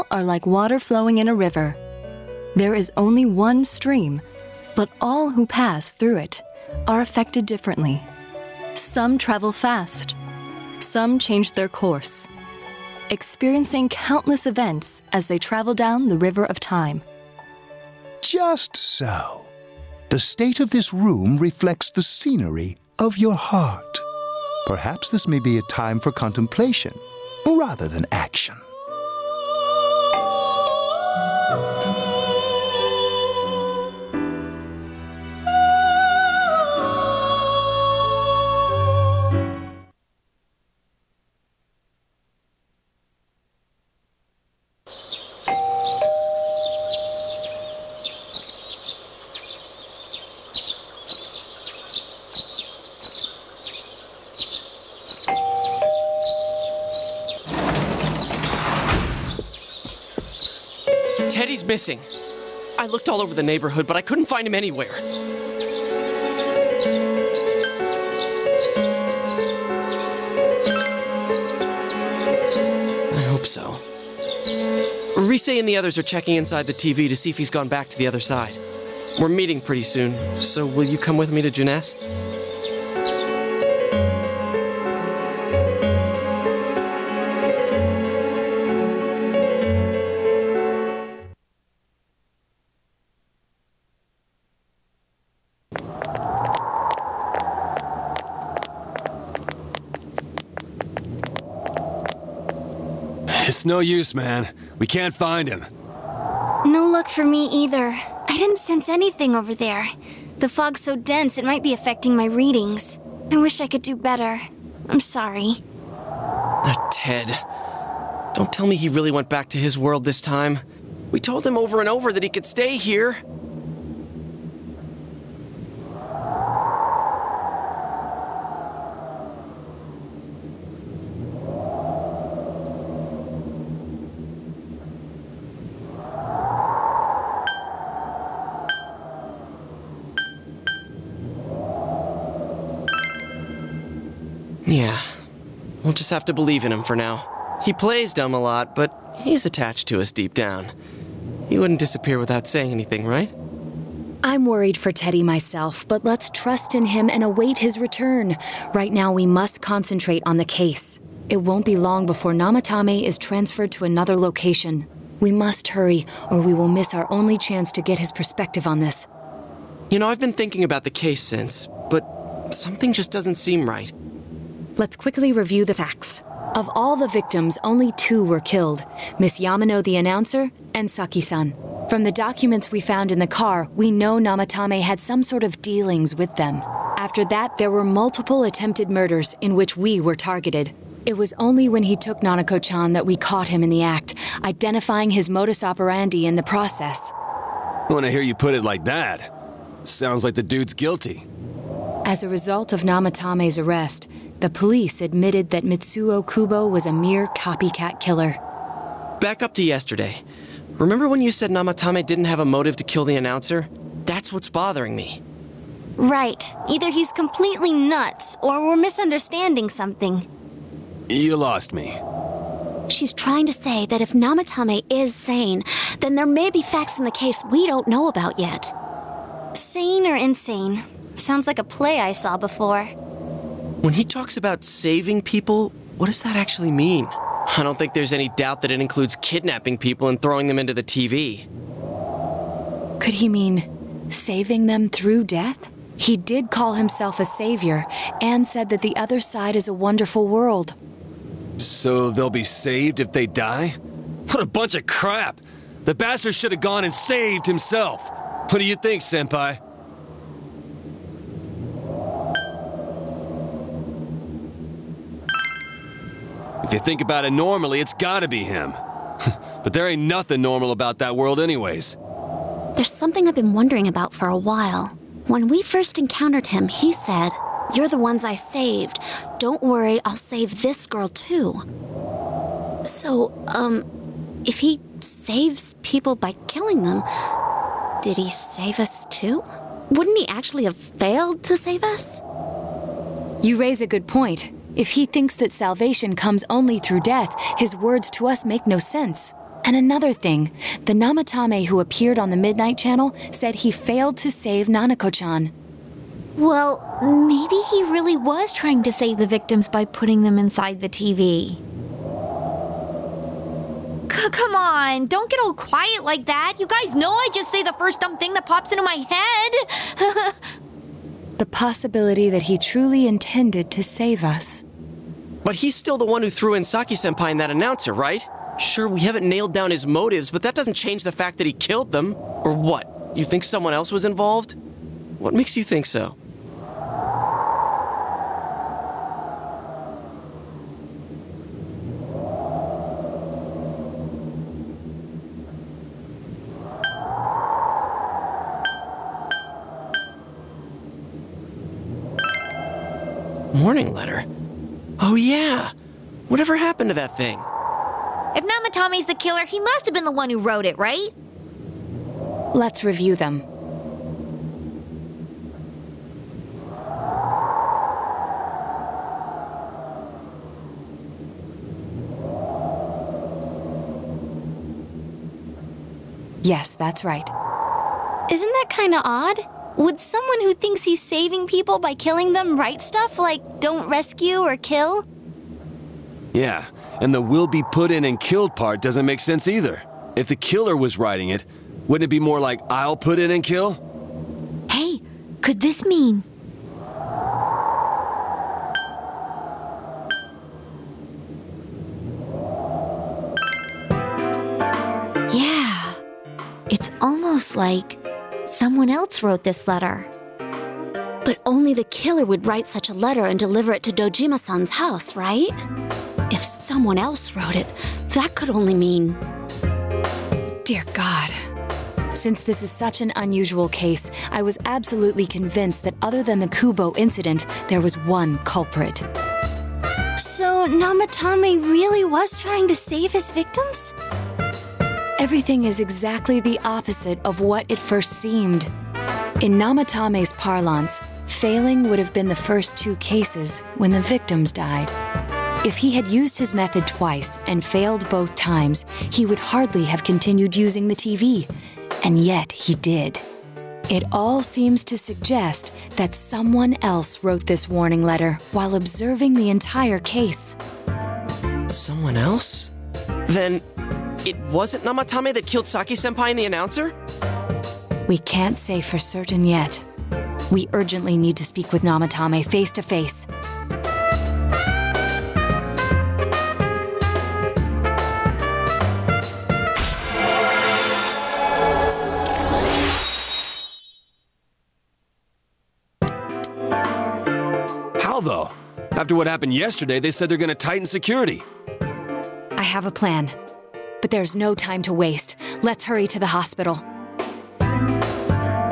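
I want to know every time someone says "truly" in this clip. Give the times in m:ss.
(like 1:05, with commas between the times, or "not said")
5:22.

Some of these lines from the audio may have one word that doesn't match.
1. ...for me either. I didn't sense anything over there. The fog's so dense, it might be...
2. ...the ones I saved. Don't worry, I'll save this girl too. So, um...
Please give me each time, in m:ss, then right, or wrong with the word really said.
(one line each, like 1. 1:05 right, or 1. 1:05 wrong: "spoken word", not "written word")
1. 1:47 right
2. 4:37 right.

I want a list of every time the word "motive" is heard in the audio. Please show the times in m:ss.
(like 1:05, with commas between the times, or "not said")
3:32, 5:29.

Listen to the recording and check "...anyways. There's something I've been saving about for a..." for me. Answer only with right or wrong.
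wrong.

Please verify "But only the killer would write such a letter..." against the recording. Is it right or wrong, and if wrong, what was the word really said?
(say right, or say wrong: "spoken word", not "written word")
right.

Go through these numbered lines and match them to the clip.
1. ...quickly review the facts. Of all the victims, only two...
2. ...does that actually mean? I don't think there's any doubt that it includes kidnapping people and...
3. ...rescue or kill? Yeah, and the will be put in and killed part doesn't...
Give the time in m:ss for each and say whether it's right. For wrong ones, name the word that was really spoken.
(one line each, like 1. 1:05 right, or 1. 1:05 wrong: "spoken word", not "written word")
1. 2:54 right
2. 3:56 right
3. 6:23 right.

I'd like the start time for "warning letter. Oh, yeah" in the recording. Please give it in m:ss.
5:53.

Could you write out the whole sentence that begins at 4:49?
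Wouldn't he actually have failed to save us?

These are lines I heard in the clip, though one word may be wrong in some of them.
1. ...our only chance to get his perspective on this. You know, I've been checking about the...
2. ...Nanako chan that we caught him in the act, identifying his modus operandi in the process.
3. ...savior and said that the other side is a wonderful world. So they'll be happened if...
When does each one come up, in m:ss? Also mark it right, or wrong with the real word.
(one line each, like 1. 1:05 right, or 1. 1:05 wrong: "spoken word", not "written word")
1. 2:46 wrong: "thinking", not "checking"
2. 3:12 right
3. 4:07 wrong: "saved", not "happened".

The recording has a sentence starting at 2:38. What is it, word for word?
Right now, we must concentrate on the case.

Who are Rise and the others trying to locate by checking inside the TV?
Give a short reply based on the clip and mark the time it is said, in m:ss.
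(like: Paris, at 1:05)
Ted, at 1:56.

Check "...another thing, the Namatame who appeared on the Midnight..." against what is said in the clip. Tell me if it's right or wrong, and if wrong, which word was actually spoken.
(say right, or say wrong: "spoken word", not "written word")
right.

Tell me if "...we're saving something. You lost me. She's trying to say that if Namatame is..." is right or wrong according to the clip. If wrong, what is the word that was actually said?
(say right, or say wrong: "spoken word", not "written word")
wrong: "misunderstanding", not "saving".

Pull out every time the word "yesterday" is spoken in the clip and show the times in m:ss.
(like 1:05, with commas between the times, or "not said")
3:29, 8:09.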